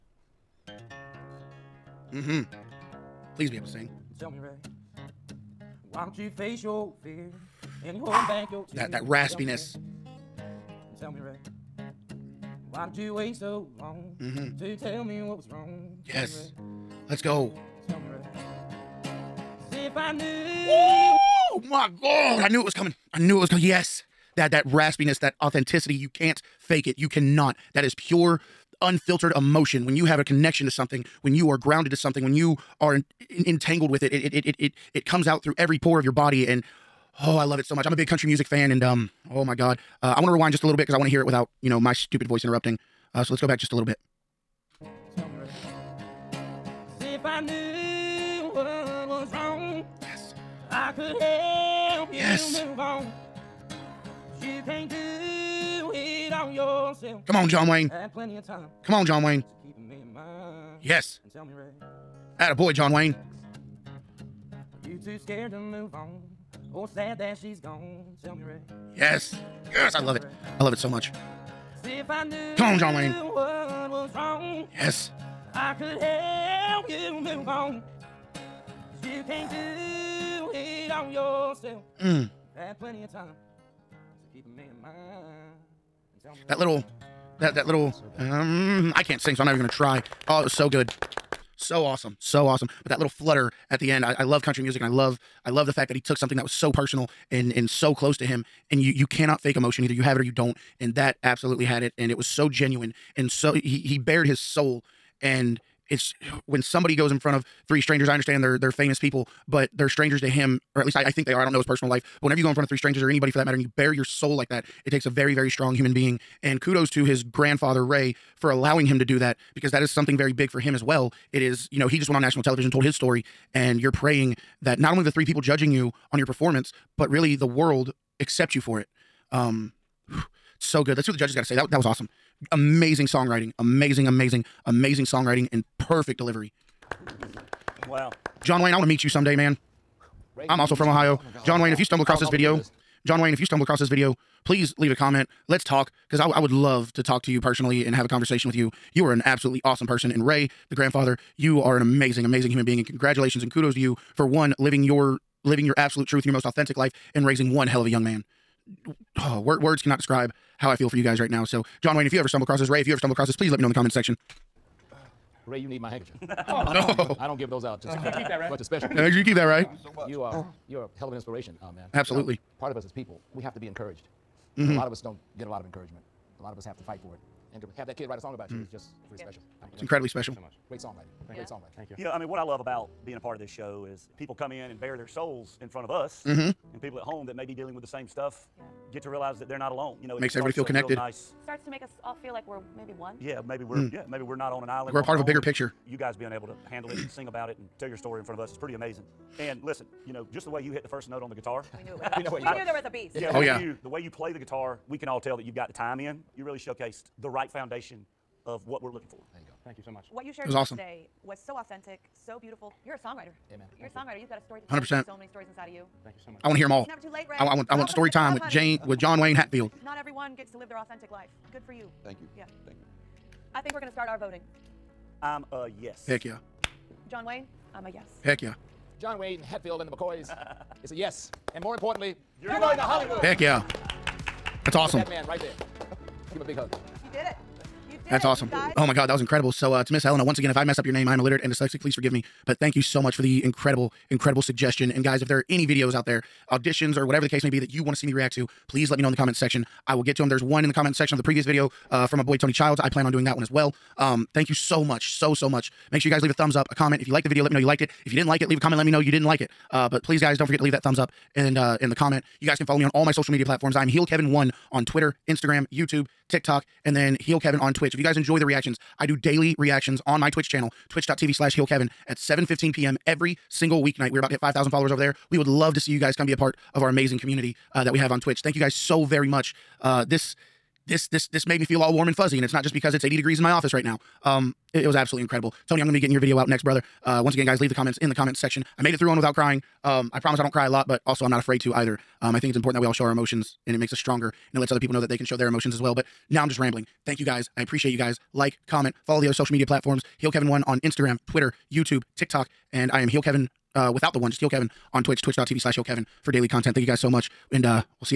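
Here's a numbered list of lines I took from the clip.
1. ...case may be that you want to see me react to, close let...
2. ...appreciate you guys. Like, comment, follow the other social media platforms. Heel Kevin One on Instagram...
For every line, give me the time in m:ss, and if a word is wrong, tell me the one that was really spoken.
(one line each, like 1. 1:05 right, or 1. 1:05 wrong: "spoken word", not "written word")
1. 4:07 wrong: "please", not "close"
2. 4:57 right.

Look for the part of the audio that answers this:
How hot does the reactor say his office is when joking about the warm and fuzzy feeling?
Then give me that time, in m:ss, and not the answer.
4:43.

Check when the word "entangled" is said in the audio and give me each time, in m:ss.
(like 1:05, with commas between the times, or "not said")
0:33.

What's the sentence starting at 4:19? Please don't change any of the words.
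Uh, but please, guys, don't forget to leave that thumbs up and uh, in the comment.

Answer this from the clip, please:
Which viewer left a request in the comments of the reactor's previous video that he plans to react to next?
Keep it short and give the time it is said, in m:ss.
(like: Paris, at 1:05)
Tony Childs, at 4:12.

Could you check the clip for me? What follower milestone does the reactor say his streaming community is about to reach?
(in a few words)
5,000.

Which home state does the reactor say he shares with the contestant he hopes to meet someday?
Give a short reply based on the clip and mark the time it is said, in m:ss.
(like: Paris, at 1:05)
Ohio, at 2:20.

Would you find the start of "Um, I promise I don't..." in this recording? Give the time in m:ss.
4:49.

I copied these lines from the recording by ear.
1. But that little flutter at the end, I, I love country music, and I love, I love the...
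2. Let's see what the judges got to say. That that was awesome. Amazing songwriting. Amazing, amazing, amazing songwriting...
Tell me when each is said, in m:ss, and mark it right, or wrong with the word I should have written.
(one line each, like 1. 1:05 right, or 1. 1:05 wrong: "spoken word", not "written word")
1. 1:32 right
2. 2:10 right.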